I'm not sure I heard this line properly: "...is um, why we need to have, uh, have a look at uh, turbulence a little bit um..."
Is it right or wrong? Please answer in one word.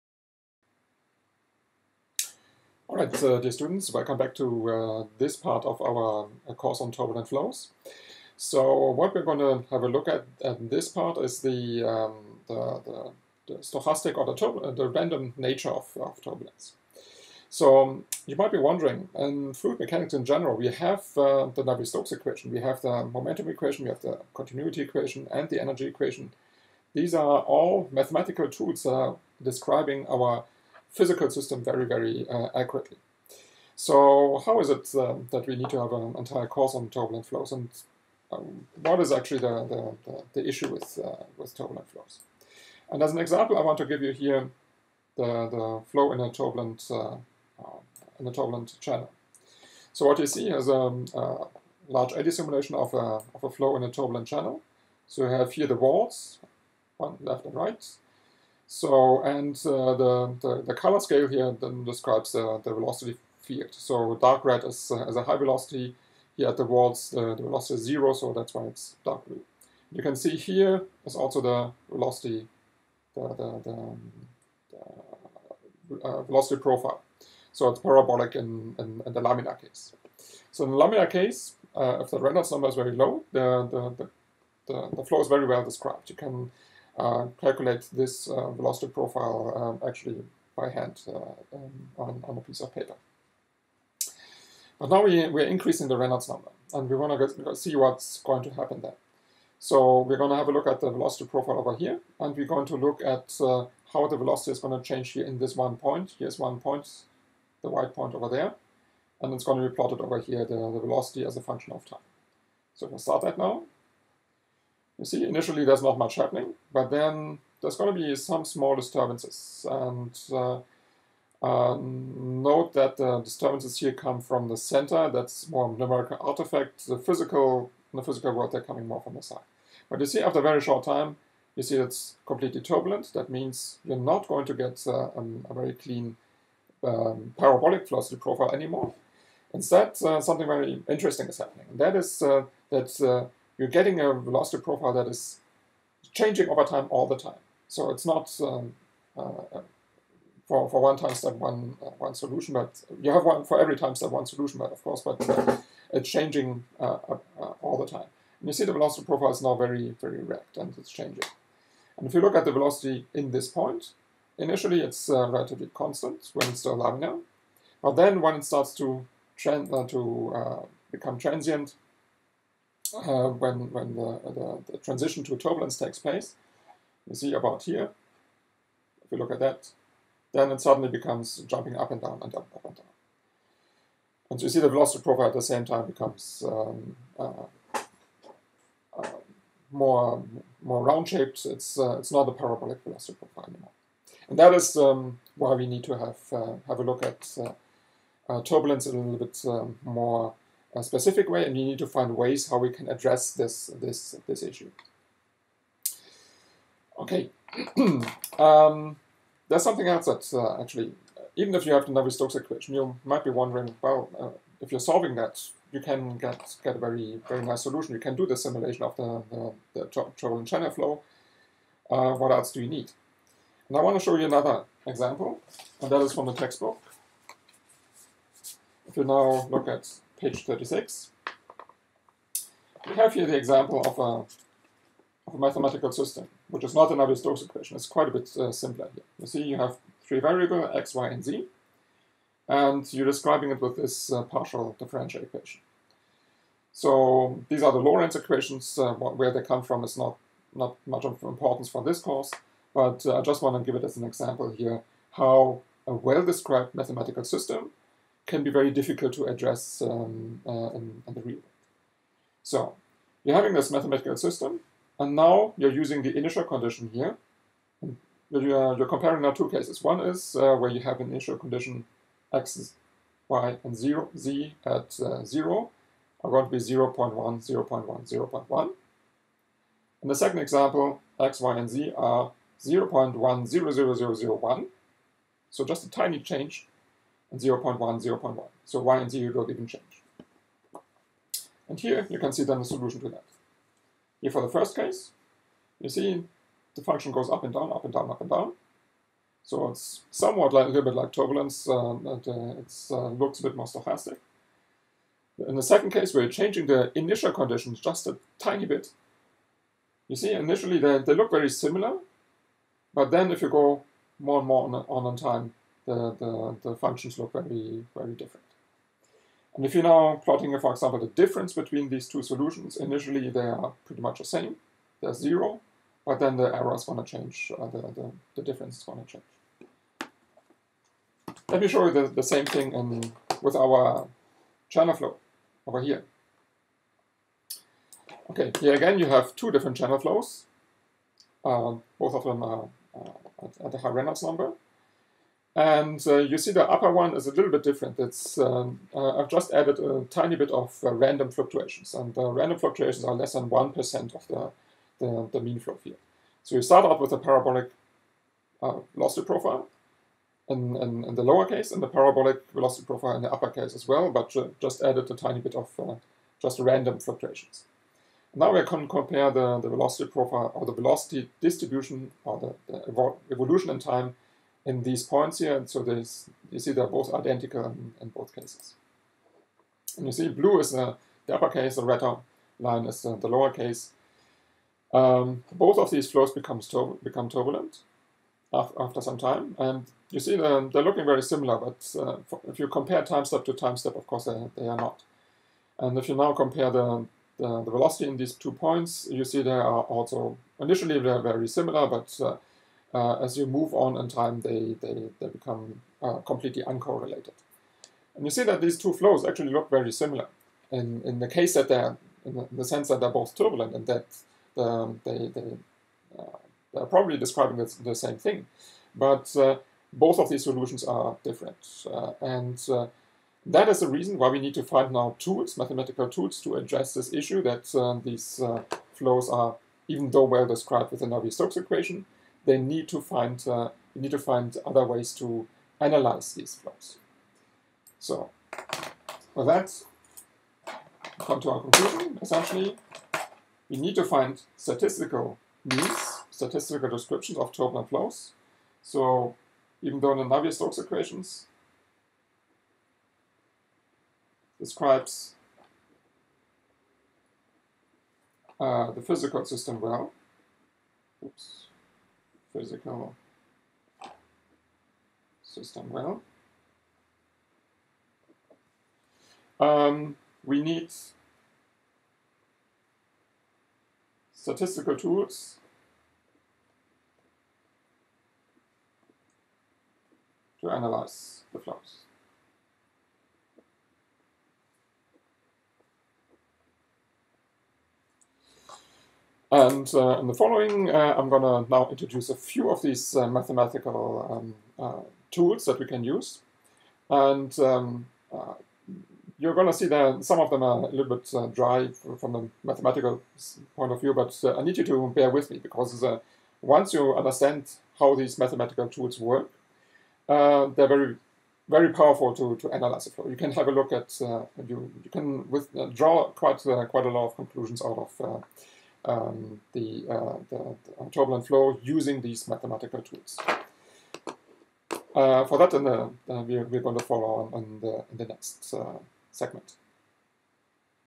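right.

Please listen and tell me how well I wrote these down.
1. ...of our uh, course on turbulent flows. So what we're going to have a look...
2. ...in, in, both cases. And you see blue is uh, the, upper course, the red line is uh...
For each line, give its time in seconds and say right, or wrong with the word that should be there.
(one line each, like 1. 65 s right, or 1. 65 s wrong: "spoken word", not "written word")
1. 5 s right
2. 377 s wrong: "uppercase", not "course".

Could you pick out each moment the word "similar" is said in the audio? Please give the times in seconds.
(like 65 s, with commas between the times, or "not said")
311 s, 391 s, 401 s, 409 s.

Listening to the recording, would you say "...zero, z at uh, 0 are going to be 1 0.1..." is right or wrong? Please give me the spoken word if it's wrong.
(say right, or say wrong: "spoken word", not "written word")
wrong: "0", not "1".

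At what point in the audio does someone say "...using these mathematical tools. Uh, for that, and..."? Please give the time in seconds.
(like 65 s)
521 s.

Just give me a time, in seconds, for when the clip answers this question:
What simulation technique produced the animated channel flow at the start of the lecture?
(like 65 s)
51 s.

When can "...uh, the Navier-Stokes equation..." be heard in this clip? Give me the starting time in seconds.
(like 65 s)
21 s.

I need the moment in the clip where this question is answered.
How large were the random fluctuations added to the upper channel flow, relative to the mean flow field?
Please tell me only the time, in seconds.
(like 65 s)
353 s.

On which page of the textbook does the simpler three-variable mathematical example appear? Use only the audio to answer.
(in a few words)
36.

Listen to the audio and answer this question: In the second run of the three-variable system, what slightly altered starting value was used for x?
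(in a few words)
0.100001.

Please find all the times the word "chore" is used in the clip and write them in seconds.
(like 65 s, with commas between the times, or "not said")
not said.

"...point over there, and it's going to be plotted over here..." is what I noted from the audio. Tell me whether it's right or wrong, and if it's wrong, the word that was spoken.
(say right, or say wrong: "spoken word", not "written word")
right.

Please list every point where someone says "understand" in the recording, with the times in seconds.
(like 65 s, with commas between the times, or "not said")
507 s.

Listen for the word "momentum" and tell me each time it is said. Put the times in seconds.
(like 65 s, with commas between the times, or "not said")
23 s.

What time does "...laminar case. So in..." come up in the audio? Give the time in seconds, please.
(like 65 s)
79 s.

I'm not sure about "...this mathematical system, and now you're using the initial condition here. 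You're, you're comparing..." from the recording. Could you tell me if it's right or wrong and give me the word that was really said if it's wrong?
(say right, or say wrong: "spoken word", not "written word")
right.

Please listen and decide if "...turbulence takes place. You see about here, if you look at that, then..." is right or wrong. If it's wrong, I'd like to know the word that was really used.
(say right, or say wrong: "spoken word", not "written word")
right.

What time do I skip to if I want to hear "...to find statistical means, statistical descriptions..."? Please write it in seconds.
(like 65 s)
443 s.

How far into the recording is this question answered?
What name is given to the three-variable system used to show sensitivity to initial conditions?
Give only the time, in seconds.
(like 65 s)
247 s.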